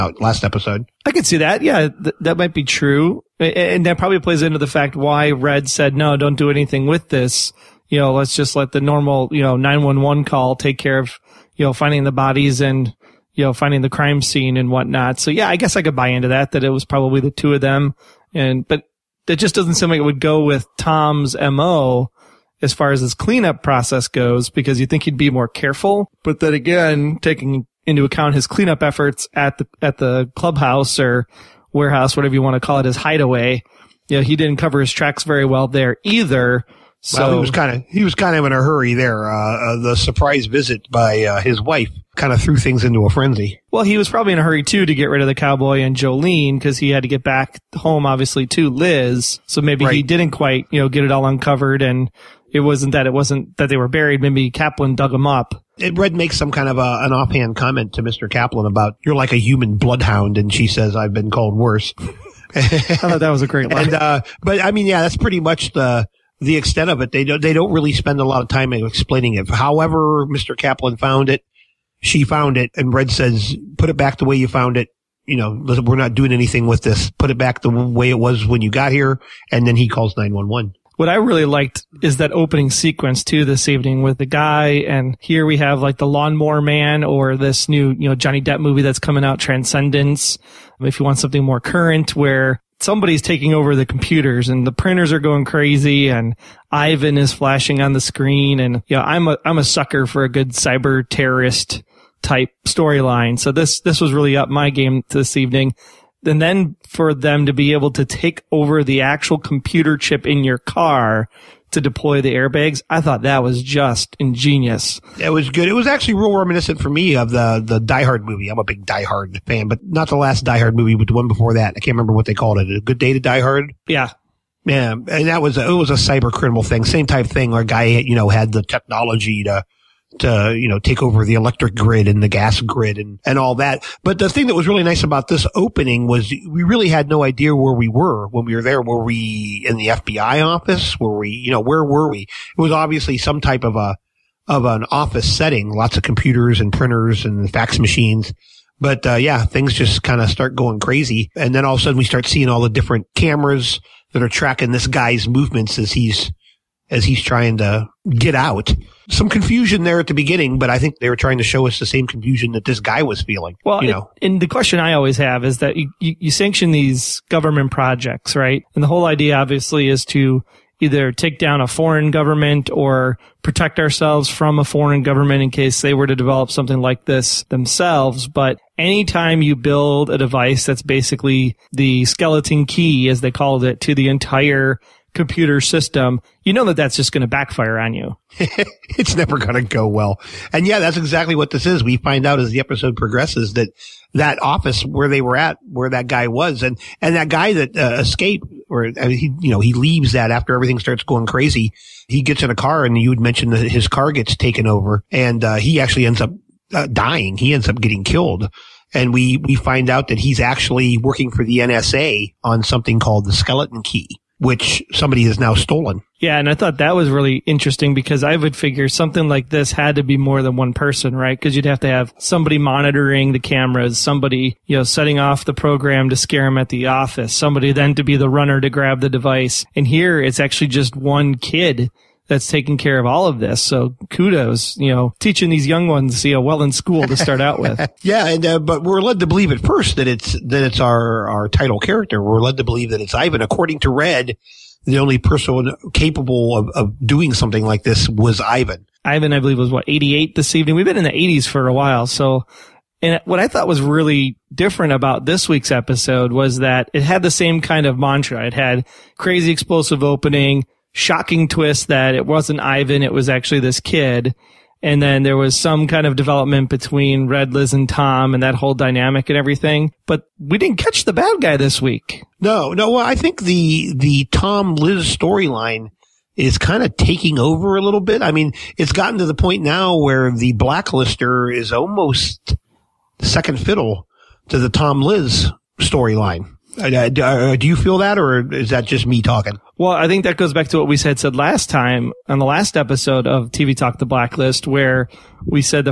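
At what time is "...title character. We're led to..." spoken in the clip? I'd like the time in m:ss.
4:01.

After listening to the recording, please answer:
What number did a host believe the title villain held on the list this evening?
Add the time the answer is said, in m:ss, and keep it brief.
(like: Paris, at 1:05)
88, at 4:09.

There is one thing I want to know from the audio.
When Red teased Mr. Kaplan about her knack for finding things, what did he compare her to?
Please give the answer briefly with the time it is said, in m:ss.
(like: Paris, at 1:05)
A human bloodhound, at 0:59.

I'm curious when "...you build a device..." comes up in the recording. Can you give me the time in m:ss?
2:59.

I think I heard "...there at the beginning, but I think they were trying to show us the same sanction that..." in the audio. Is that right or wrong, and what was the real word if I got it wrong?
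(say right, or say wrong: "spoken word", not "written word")
wrong: "confusion", not "sanction".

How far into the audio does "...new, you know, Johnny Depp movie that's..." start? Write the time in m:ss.
1:27.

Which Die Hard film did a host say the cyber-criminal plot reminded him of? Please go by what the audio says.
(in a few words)
A Good Day to Die Hard.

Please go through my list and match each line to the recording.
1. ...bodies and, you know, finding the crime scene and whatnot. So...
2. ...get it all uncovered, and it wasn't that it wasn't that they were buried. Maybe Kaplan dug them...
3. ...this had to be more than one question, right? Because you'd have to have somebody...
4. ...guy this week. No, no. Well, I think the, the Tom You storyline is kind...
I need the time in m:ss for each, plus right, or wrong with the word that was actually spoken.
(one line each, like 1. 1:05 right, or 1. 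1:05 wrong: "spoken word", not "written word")
1. 0:12 right
2. 0:50 right
3. 3:39 wrong: "person", not "question"
4. 4:31 wrong: "Liz", not "You".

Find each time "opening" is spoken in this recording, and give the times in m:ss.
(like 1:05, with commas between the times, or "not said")
1:22, 2:15, 4:20.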